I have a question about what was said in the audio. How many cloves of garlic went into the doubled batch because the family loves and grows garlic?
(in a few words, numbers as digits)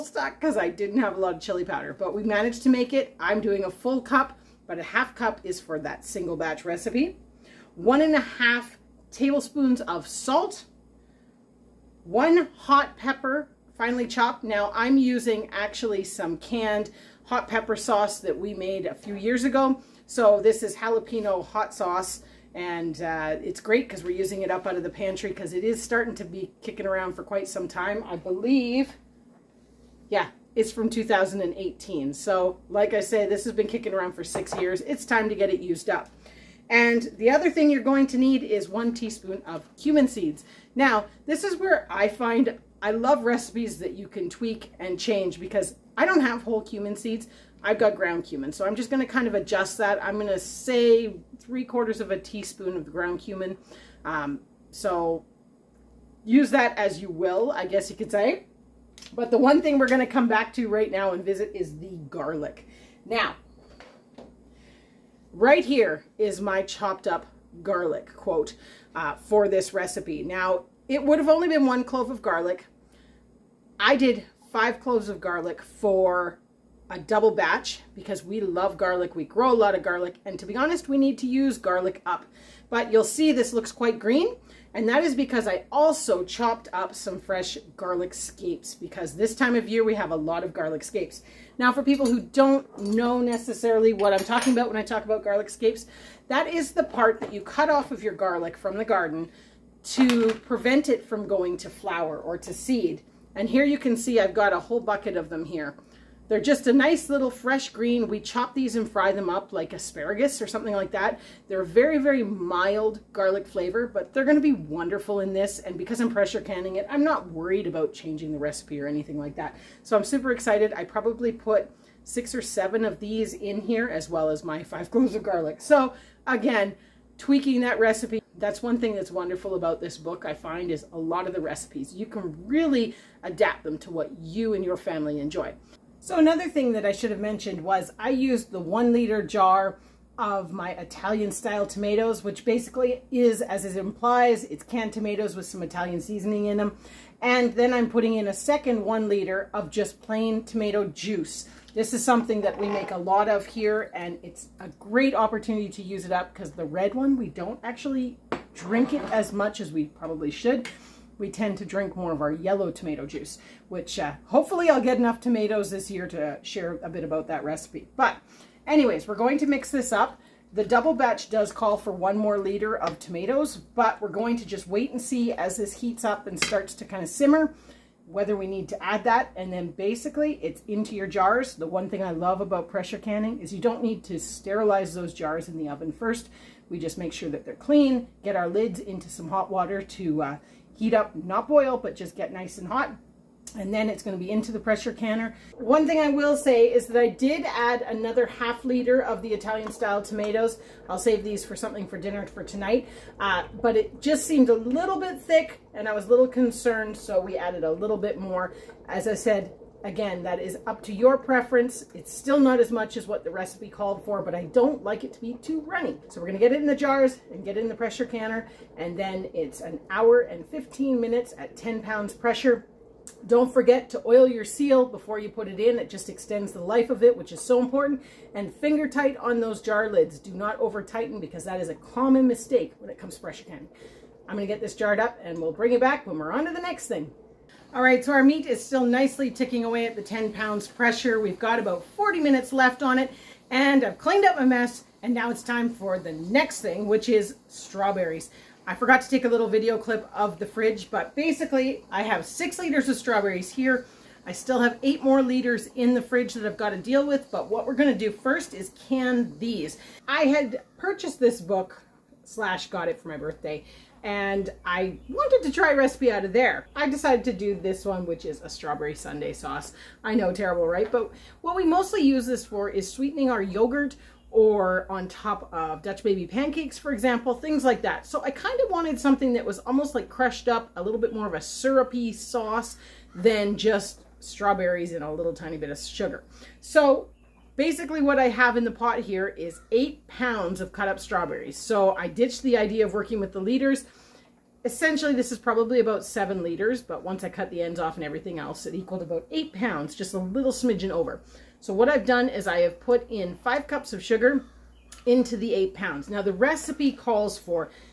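5.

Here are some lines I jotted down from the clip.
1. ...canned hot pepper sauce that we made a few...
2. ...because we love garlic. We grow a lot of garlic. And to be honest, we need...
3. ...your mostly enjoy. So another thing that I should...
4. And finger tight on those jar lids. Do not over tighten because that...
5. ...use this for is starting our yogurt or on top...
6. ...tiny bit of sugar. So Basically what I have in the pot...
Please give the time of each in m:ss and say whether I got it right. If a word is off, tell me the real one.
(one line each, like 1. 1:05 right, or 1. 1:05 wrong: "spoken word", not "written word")
1. 0:16 right
2. 1:17 right
3. 2:14 wrong: "family", not "mostly"
4. 3:48 right
5. 4:31 wrong: "sweetening", not "starting"
6. 4:45 right.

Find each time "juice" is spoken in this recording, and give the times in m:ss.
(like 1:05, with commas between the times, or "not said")
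2:30, 2:43.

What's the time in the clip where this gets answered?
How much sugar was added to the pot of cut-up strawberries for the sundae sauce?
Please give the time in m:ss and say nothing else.
5:03.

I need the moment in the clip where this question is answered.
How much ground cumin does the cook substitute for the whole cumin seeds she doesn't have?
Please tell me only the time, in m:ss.
0:51.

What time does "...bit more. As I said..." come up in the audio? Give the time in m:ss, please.
3:27.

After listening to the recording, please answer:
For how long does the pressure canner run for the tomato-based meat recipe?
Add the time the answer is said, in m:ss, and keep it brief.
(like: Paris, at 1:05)
1 hour 15 minutes, at 3:39.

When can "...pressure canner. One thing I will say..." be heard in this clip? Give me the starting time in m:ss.
3:14.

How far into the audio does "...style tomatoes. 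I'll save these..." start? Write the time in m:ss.
3:19.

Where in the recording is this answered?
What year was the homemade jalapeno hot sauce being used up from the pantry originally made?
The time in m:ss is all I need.
0:30.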